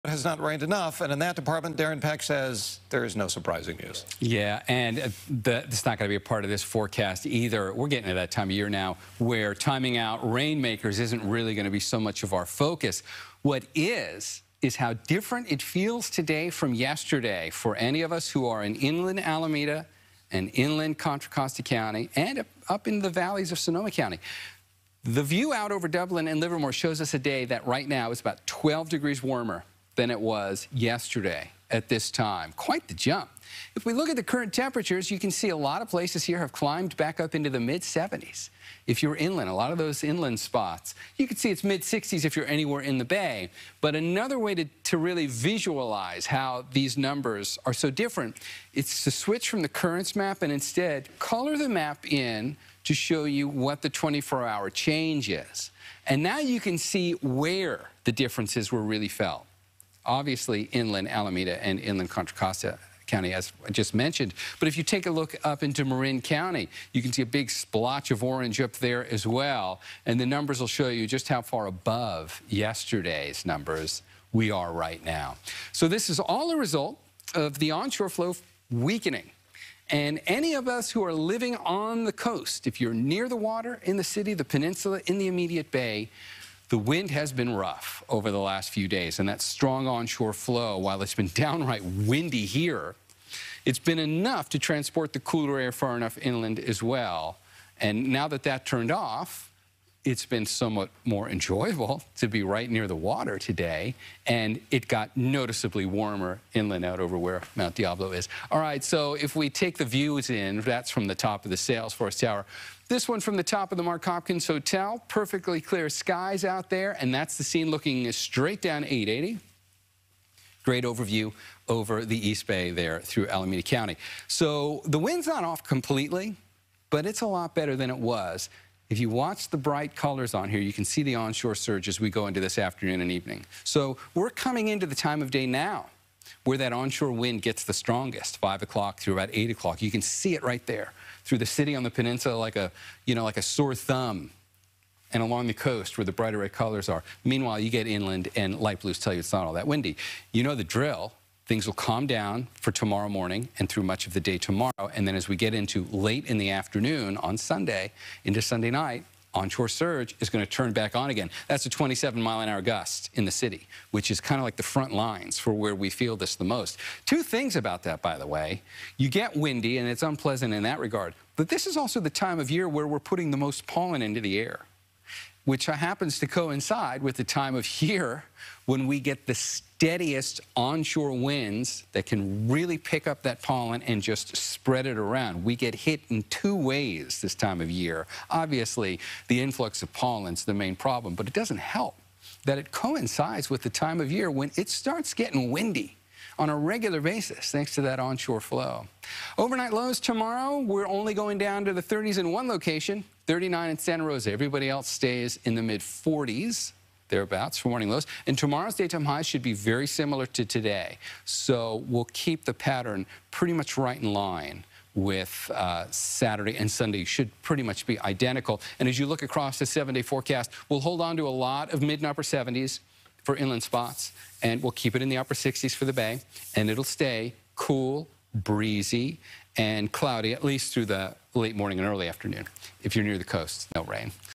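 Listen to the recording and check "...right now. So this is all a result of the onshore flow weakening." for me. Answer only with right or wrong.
right.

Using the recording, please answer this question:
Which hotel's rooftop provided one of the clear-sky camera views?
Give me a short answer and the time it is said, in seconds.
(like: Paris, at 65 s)
Mark Hopkins Hotel, at 113 s.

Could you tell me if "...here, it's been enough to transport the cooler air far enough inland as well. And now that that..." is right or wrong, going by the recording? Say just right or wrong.
right.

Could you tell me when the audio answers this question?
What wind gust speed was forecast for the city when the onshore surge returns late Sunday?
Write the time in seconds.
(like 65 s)
161 s.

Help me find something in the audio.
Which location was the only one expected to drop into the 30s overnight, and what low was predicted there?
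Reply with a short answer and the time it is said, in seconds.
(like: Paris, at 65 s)
Santa Rosa, 39, at 203 s.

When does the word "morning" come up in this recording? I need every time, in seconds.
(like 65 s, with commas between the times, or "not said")
153 s, 207 s, 231 s.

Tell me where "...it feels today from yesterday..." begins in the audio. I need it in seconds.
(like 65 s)
15 s.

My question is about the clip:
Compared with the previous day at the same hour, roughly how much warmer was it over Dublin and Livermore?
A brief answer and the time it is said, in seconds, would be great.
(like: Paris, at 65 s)
12 degrees, at 28 s.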